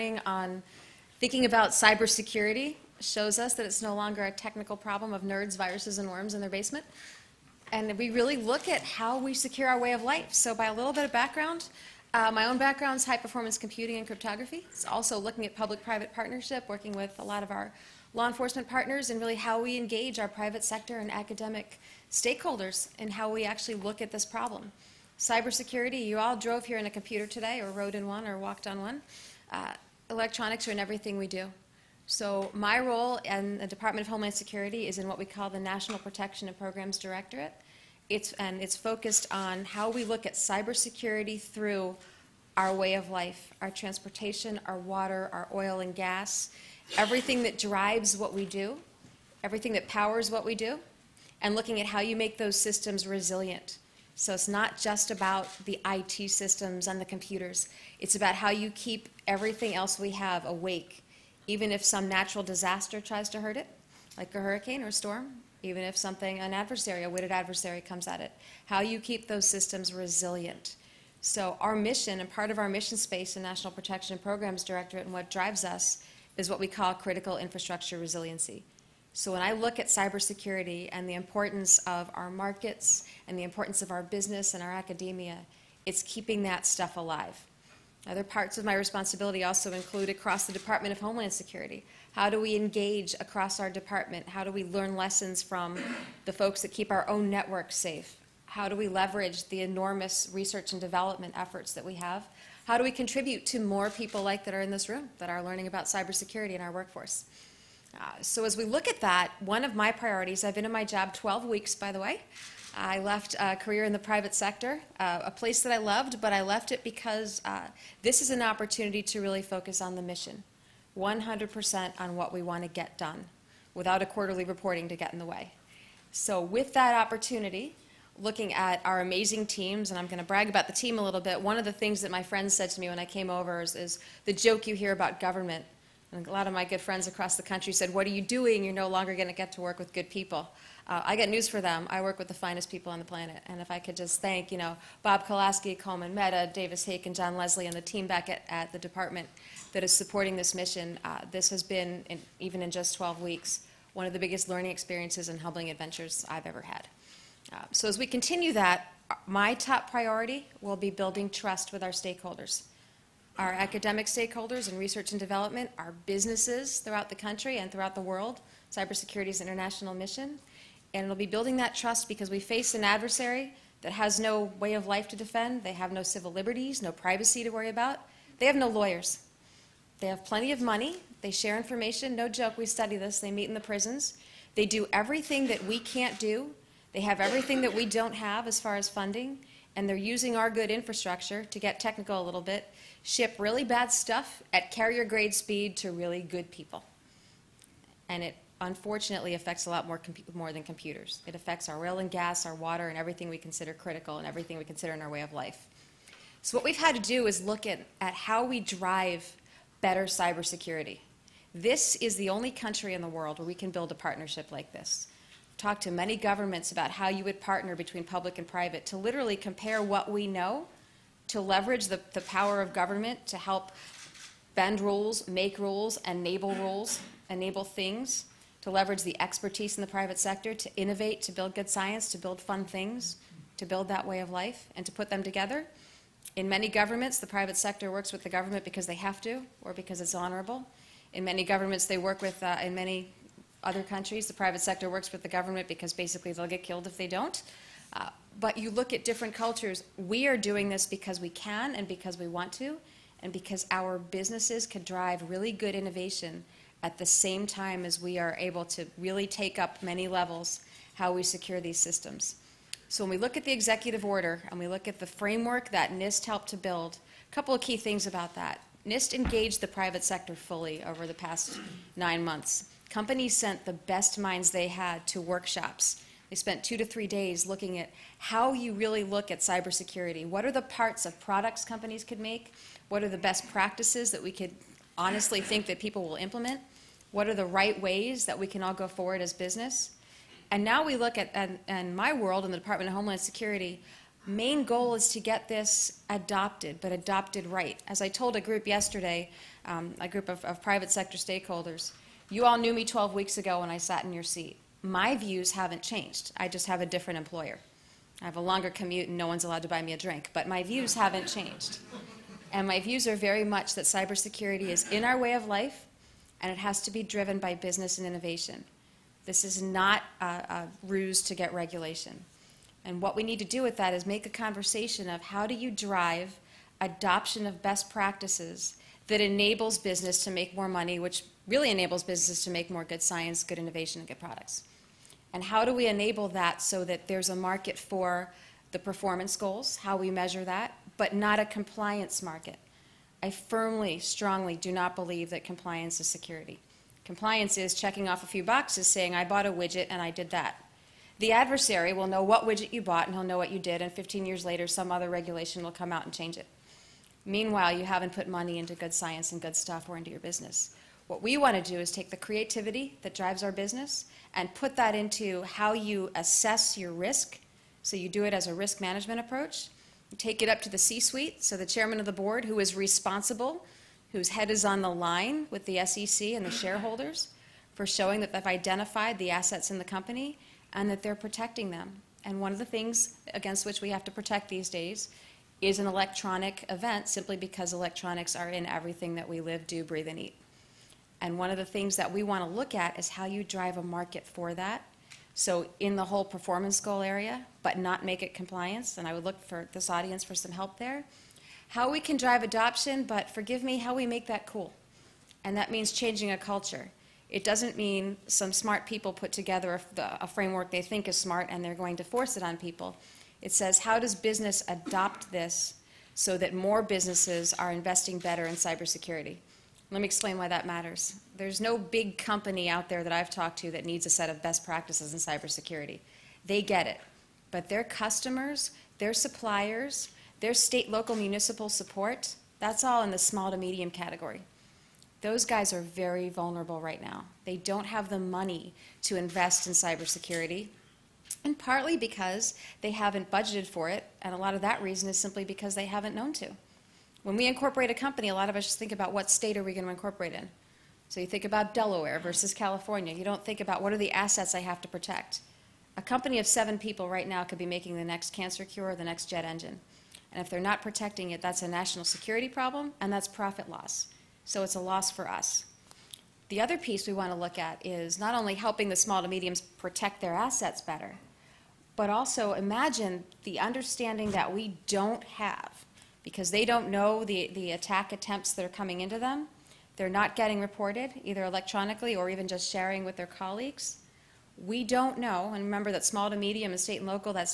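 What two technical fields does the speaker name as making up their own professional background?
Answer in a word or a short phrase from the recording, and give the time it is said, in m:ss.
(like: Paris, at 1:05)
High performance computing and cryptography, at 0:13.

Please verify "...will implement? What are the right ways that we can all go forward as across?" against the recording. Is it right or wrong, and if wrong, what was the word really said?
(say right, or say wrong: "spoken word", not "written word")
wrong: "business", not "across".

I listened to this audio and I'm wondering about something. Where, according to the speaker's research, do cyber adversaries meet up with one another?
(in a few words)
In the prisons.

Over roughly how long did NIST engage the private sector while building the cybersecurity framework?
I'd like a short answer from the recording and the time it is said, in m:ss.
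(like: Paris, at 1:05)
Past nine months, at 4:31.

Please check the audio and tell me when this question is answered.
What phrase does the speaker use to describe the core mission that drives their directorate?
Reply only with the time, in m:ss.
1:16.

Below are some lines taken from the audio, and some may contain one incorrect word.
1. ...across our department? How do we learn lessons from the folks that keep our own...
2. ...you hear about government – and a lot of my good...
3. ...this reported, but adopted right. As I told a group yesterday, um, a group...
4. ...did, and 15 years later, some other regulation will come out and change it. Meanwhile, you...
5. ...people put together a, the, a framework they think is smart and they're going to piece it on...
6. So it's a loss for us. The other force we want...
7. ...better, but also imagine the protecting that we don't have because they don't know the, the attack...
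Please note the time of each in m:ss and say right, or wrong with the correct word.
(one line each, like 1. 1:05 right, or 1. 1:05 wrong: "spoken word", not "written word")
1. 1:33 right
2. 2:14 right
3. 4:55 wrong: "adopted", not "reported"
4. 5:53 right
5. 6:48 wrong: "force", not "piece"
6. 7:44 wrong: "piece", not "force"
7. 7:50 wrong: "understanding", not "protecting".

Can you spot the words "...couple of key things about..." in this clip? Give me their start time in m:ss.
4:27.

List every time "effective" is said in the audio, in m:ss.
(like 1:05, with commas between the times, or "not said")
not said.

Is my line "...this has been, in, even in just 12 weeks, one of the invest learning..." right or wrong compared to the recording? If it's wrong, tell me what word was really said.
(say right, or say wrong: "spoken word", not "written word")
wrong: "biggest", not "invest".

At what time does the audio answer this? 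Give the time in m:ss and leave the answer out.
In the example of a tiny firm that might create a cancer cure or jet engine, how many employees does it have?
7:36.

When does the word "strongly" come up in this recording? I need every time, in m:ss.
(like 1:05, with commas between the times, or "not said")
5:43.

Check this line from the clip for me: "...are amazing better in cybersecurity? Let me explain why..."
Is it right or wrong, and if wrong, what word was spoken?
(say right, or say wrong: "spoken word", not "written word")
wrong: "investing", not "amazing".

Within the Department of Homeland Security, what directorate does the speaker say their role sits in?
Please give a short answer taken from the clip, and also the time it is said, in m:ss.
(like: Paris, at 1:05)
National Protection and Programs Directorate, at 0:35.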